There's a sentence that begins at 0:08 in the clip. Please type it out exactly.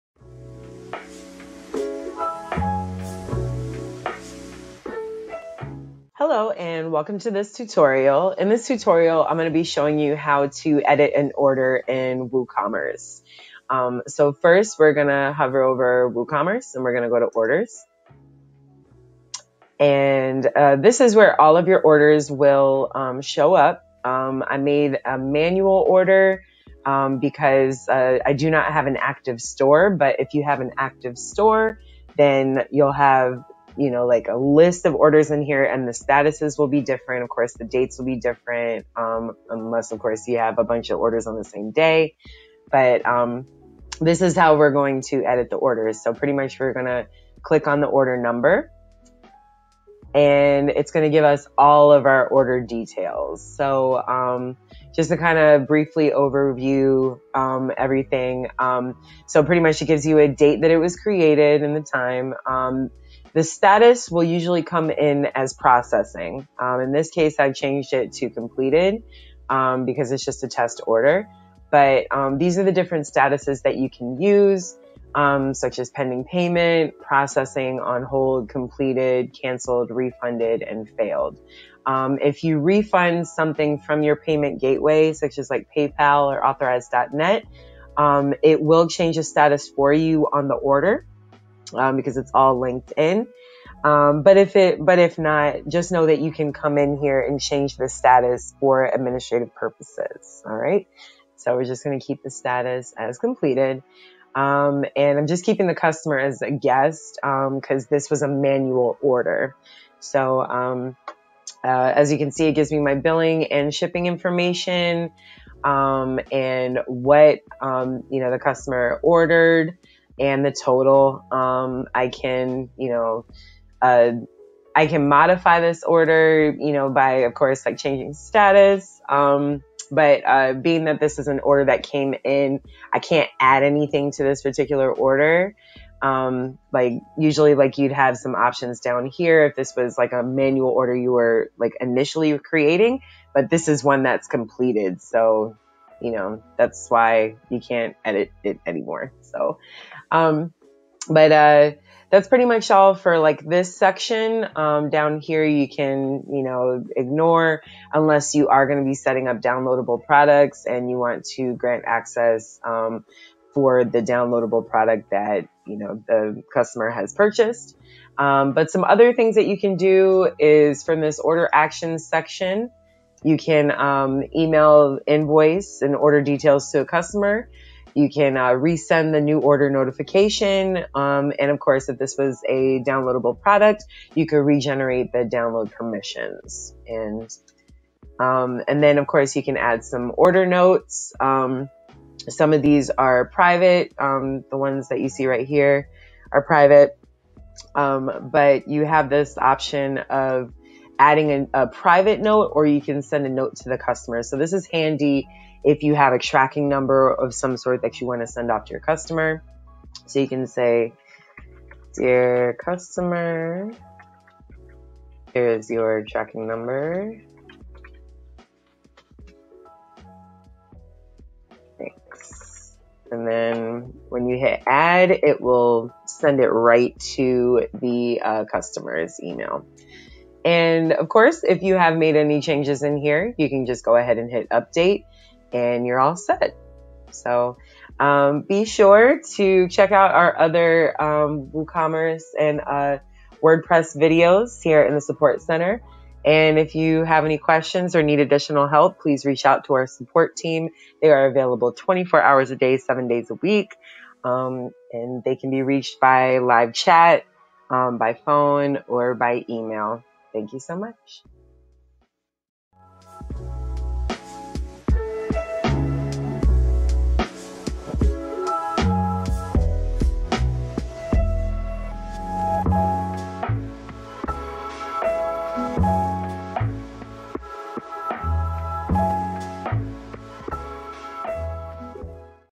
In this tutorial, I'm going to be showing you how to edit an order in WooCommerce.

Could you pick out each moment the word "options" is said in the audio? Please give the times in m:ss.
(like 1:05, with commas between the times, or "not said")
2:18, 3:19.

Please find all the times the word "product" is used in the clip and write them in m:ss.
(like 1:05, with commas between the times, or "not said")
2:40, 2:44, 3:03.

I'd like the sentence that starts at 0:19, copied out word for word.
And uh, this is where all of your orders will um, show up.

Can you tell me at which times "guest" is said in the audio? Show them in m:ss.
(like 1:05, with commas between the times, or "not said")
1:46.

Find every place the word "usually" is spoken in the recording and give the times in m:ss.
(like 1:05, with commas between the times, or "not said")
1:04, 2:17.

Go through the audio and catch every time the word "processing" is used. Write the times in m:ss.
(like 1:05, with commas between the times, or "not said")
1:05, 1:16.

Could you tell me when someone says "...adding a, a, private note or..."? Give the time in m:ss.
3:21.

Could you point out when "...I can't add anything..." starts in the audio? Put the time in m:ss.
2:12.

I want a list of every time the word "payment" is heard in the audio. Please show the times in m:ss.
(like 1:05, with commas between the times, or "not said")
1:16, 1:24.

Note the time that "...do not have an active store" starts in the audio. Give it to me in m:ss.
0:28.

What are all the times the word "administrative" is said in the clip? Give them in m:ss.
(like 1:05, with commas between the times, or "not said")
1:38.